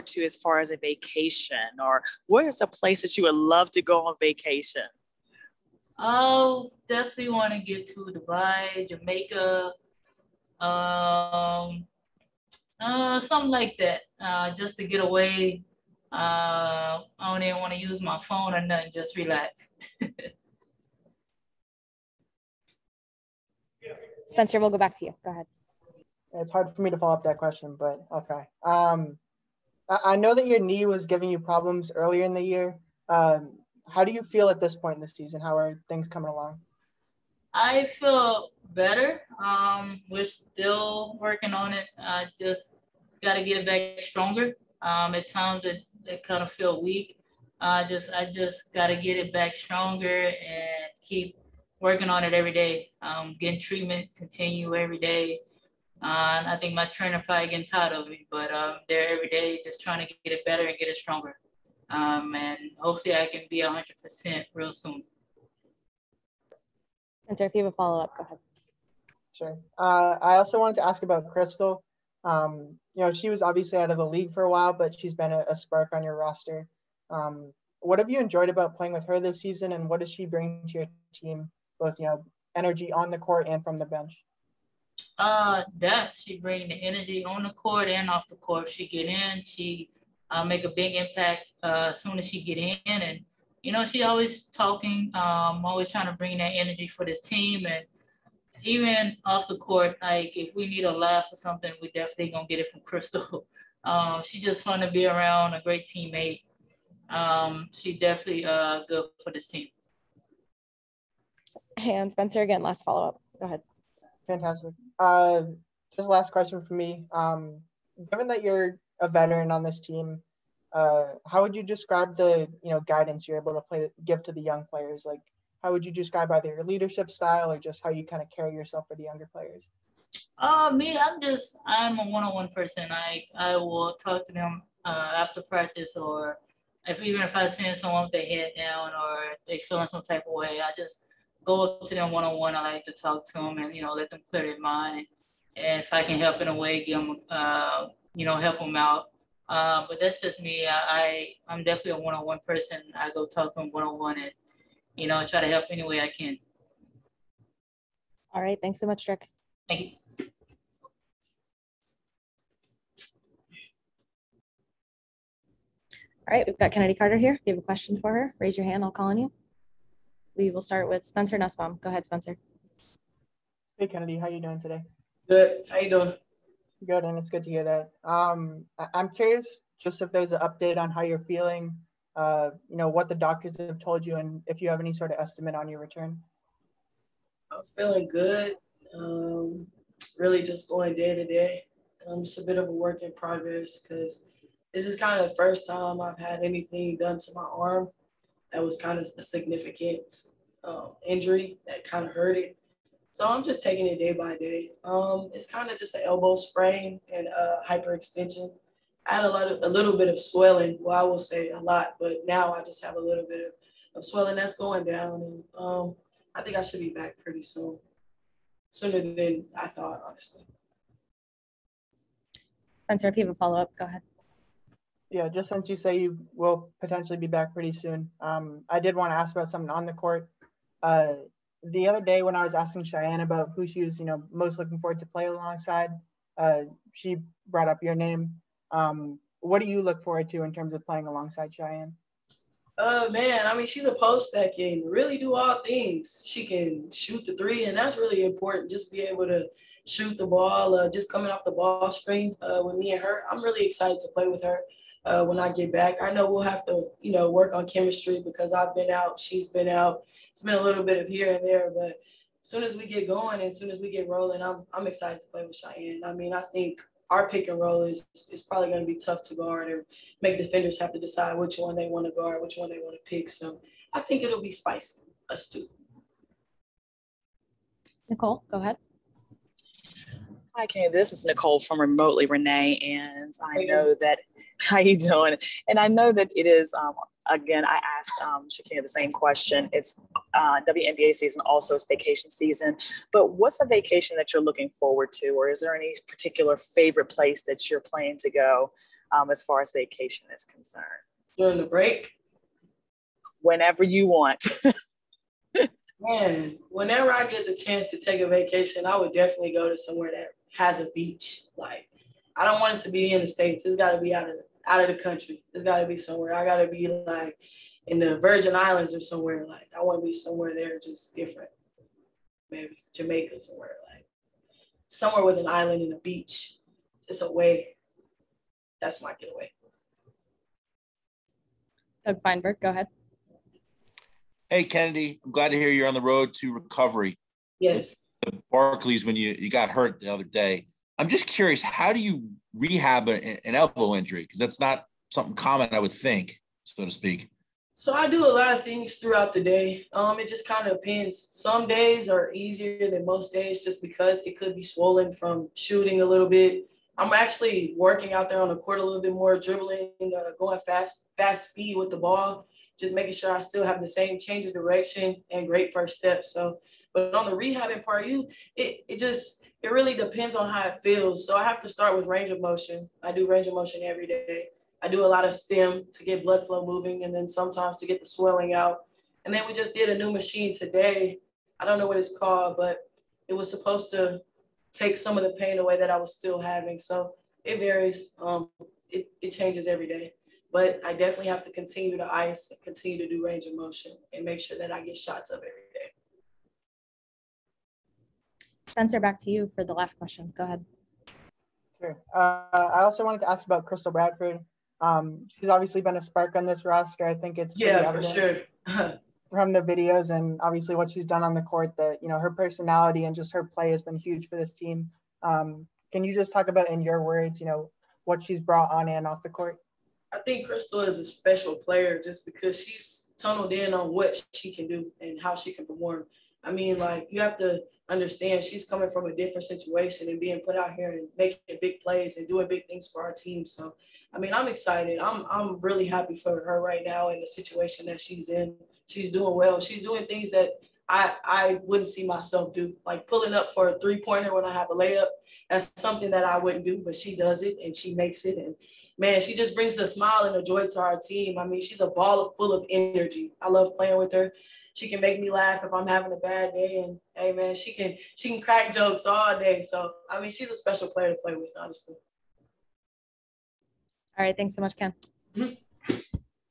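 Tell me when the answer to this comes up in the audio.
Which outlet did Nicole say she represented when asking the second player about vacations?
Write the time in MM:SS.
04:41.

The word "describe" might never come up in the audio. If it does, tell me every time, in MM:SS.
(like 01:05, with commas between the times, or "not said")
02:01, 02:05.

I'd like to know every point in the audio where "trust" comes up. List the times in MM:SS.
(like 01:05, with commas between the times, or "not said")
not said.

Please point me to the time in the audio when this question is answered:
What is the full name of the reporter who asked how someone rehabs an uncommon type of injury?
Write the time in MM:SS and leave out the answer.
05:32.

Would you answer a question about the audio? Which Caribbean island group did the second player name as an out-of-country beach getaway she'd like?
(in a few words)
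Virgin Islands.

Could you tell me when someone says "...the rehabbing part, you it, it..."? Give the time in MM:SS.
06:07.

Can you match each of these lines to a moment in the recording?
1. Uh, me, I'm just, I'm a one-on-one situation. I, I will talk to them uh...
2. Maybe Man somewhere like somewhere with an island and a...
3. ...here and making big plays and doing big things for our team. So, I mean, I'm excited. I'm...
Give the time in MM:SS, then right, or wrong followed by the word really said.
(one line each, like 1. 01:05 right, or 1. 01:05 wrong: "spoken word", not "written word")
1. 02:10 wrong: "person", not "situation"
2. 05:22 wrong: "Jamaica", not "Man"
3. 07:10 right.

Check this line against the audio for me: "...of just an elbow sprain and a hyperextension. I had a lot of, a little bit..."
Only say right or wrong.
right.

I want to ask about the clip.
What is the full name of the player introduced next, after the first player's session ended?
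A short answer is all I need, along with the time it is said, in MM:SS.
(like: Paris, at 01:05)
Kennedy Carter, at 02:46.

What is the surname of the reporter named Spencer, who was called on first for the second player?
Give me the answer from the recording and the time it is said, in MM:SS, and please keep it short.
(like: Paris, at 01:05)
Nussbaum, at 02:51.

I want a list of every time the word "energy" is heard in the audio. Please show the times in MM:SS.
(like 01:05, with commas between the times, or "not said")
01:22, 01:26, 01:36, 07:32.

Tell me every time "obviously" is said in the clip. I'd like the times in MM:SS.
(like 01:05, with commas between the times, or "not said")
01:13, 06:45, 06:50.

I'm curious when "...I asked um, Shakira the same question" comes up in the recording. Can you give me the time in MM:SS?
04:47.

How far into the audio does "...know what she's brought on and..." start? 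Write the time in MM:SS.
06:57.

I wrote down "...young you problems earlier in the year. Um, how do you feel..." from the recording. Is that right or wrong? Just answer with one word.
wrong.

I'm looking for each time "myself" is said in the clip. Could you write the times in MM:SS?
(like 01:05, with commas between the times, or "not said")
07:22.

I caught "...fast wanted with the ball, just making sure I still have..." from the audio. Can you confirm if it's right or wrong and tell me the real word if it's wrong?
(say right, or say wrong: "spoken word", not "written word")
wrong: "speed", not "wanted".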